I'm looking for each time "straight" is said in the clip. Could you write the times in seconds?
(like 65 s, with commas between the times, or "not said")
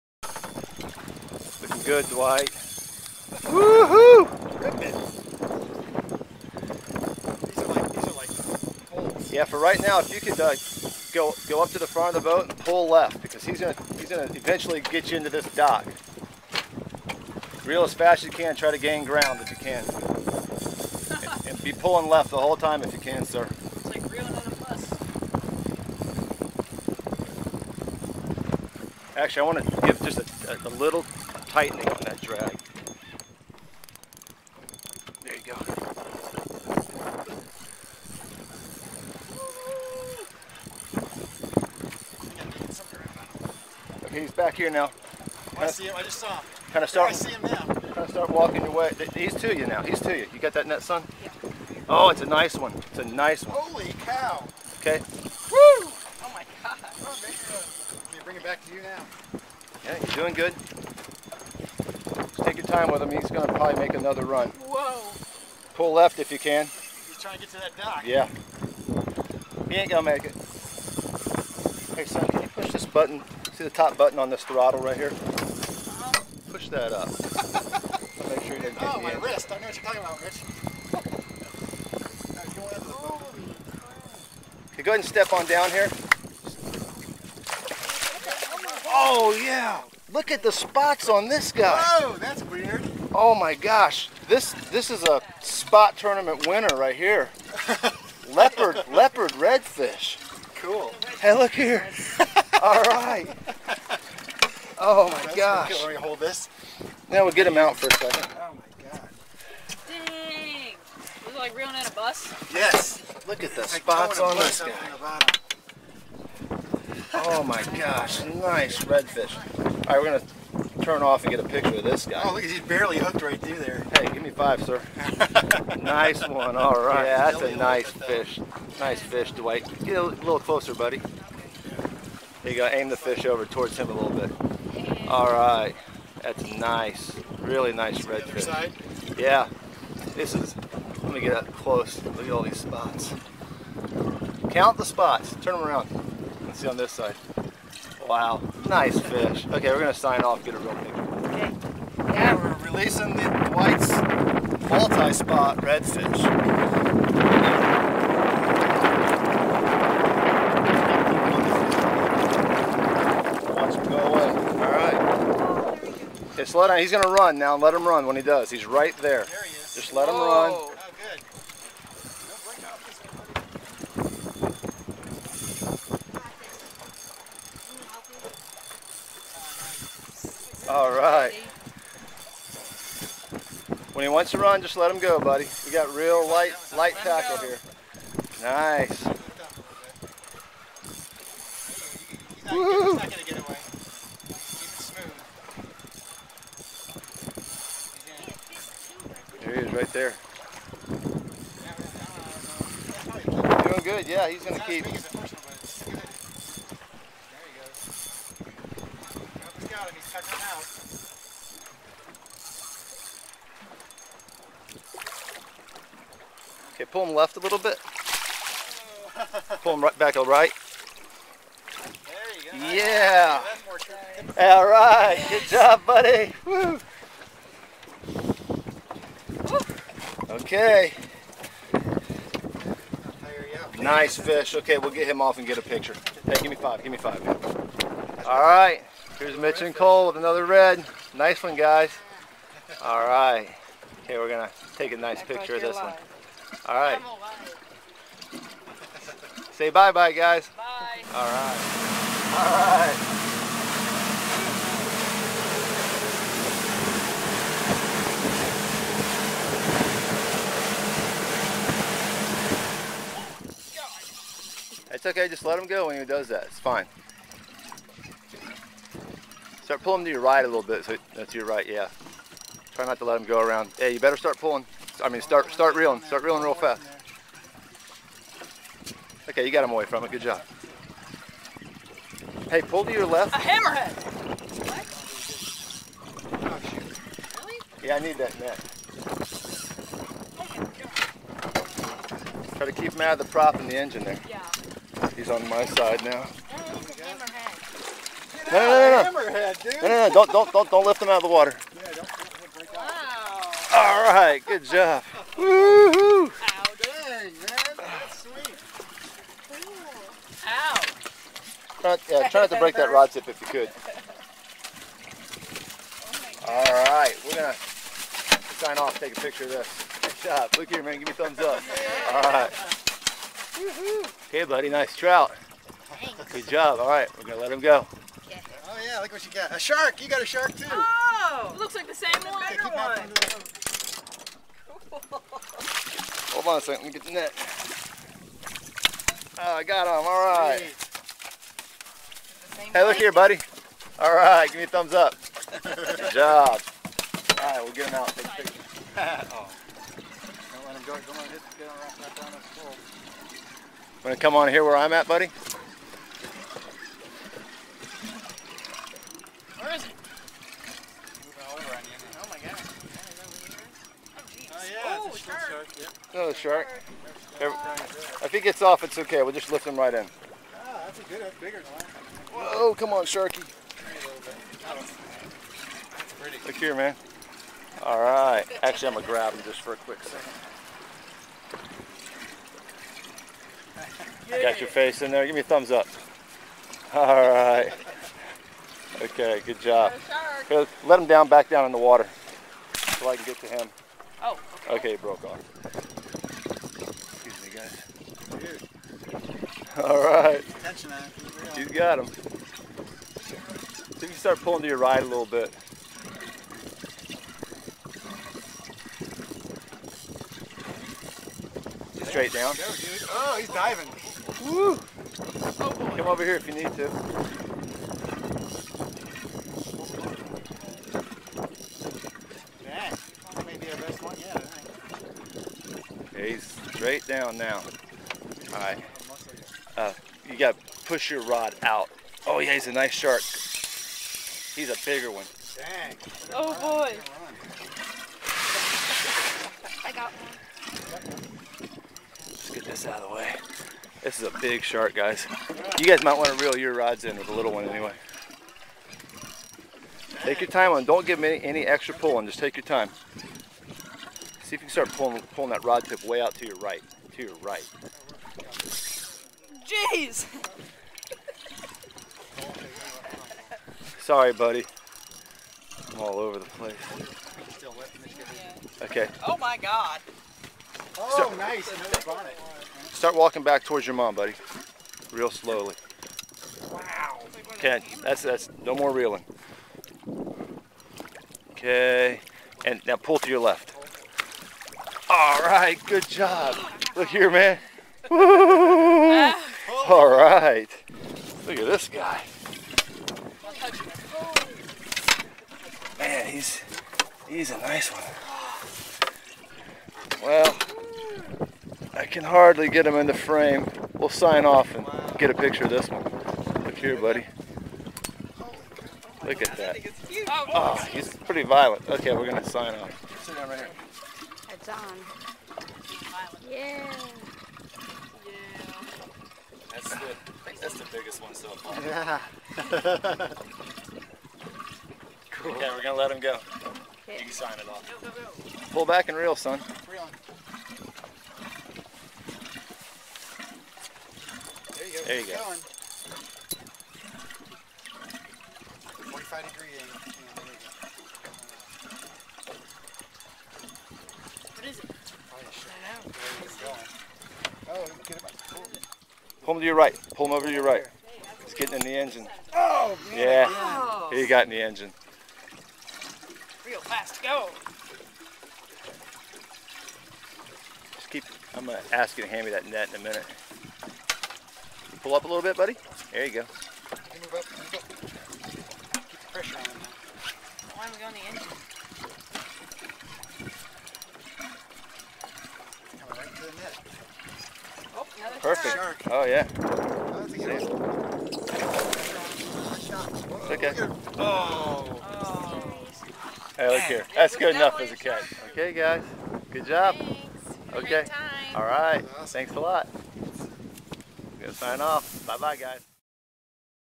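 412 s, 426 s.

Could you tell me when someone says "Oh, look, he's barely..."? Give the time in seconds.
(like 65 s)
122 s.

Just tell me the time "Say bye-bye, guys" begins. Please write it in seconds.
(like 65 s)
249 s.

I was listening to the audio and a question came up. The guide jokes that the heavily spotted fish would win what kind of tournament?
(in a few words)
spot tournament.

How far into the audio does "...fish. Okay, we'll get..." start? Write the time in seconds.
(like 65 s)
234 s.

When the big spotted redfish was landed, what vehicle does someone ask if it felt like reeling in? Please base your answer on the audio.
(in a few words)
a bus.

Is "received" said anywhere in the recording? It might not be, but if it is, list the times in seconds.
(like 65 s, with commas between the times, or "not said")
not said.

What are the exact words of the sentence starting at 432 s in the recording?
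Oh, yeah, he's a nice shark.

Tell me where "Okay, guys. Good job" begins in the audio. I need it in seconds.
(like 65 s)
588 s.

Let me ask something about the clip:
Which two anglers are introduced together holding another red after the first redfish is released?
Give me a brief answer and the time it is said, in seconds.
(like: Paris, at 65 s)
Mitch and Cole, at 239 s.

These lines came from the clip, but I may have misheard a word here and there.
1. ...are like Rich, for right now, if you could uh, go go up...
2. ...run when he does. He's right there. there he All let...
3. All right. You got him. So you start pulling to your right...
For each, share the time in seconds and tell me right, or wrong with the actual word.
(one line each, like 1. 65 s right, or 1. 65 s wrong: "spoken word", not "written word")
1. 8 s wrong: "Yeah", not "Rich"
2. 167 s wrong: "Just", not "All"
3. 399 s right.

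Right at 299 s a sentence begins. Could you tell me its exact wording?
Yeah, don't don't don't don't lift him out of the water.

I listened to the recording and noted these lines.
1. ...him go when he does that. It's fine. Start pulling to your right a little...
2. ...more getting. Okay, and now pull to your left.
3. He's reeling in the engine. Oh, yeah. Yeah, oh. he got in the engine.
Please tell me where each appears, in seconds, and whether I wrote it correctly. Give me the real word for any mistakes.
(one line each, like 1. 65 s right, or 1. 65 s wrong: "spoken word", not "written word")
1. 265 s right
2. 478 s wrong: "reeling", not "getting"
3. 551 s wrong: "getting", not "reeling".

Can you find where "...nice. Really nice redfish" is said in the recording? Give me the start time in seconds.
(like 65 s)
136 s.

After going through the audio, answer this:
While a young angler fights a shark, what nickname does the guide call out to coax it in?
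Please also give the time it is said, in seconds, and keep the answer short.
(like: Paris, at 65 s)
Sharky, at 373 s.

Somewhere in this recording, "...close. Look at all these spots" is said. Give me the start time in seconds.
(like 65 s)
141 s.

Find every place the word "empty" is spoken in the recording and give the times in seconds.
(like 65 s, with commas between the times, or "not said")
not said.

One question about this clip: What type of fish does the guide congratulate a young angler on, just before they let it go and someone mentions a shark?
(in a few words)
trout.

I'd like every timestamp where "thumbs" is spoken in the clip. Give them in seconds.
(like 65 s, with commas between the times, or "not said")
321 s, 344 s, 385 s.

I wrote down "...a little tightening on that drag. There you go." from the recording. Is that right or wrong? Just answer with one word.
right.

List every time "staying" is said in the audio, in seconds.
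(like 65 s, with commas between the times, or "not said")
not said.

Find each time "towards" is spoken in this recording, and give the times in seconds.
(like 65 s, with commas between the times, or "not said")
133 s, 473 s.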